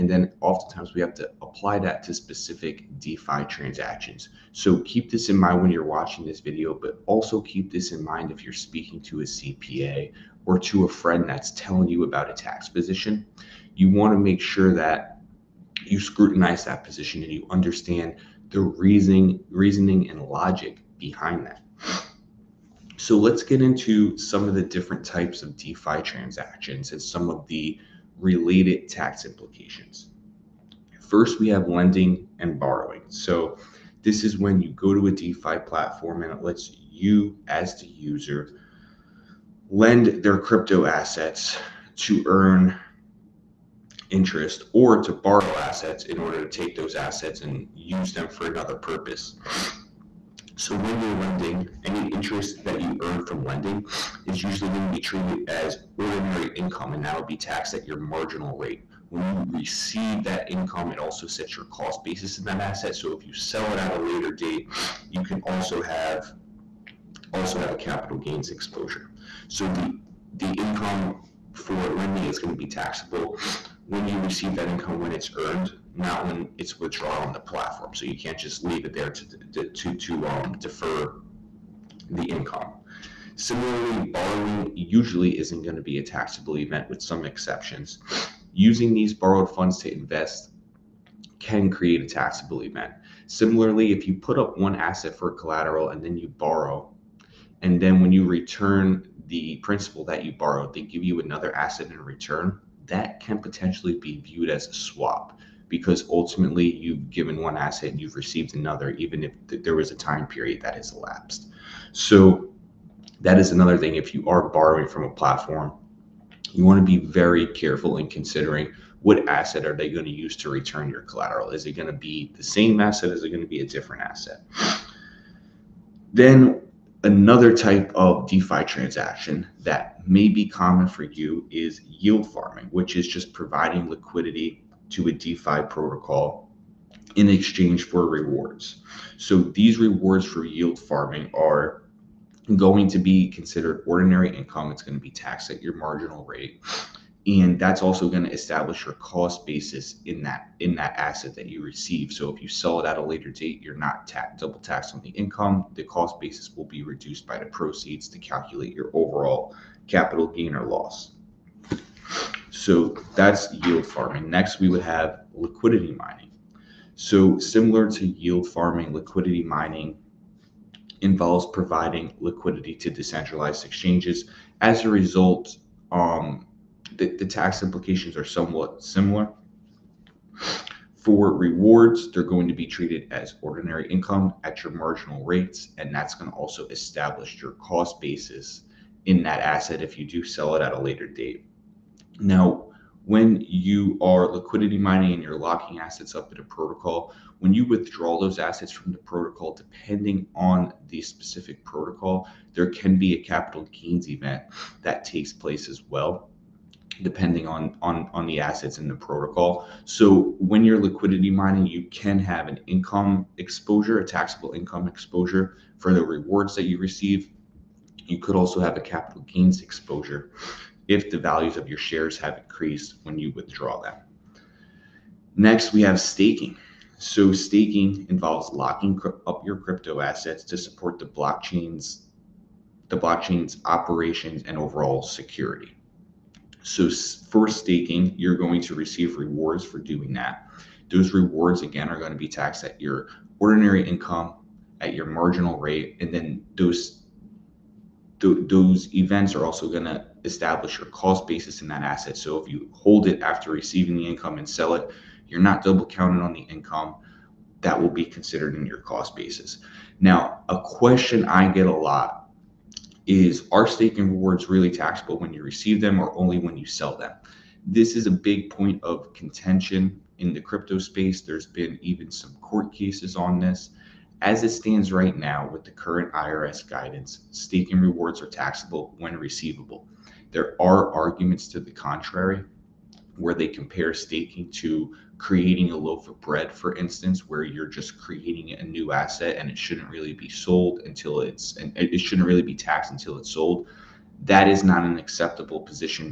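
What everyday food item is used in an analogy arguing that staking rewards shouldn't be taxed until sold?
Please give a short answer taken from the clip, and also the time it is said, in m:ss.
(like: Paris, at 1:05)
A loaf of bread, at 4:45.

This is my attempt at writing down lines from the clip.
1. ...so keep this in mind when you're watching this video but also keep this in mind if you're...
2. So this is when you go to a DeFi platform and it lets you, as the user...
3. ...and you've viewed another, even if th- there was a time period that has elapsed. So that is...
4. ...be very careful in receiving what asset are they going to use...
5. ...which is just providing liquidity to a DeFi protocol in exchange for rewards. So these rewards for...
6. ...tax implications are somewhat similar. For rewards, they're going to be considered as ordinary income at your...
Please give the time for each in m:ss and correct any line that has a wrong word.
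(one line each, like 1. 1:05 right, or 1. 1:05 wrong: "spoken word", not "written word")
1. 0:04 right
2. 0:33 right
3. 1:47 wrong: "received", not "viewed"
4. 1:56 wrong: "considering", not "receiving"
5. 2:12 right
6. 2:57 wrong: "treated", not "considered".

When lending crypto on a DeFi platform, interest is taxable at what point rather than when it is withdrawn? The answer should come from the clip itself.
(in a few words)
When it's earned.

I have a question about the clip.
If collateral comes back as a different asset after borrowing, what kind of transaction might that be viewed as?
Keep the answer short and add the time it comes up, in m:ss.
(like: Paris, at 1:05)
A swap, at 1:44.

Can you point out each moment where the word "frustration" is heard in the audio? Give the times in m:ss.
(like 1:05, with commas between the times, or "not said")
not said.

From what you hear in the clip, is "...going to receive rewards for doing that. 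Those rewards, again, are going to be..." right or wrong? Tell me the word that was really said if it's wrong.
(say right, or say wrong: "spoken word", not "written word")
right.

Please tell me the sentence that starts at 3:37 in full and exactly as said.
You could also have a capital gains exposure if the values of your shares have increased when you withdraw them.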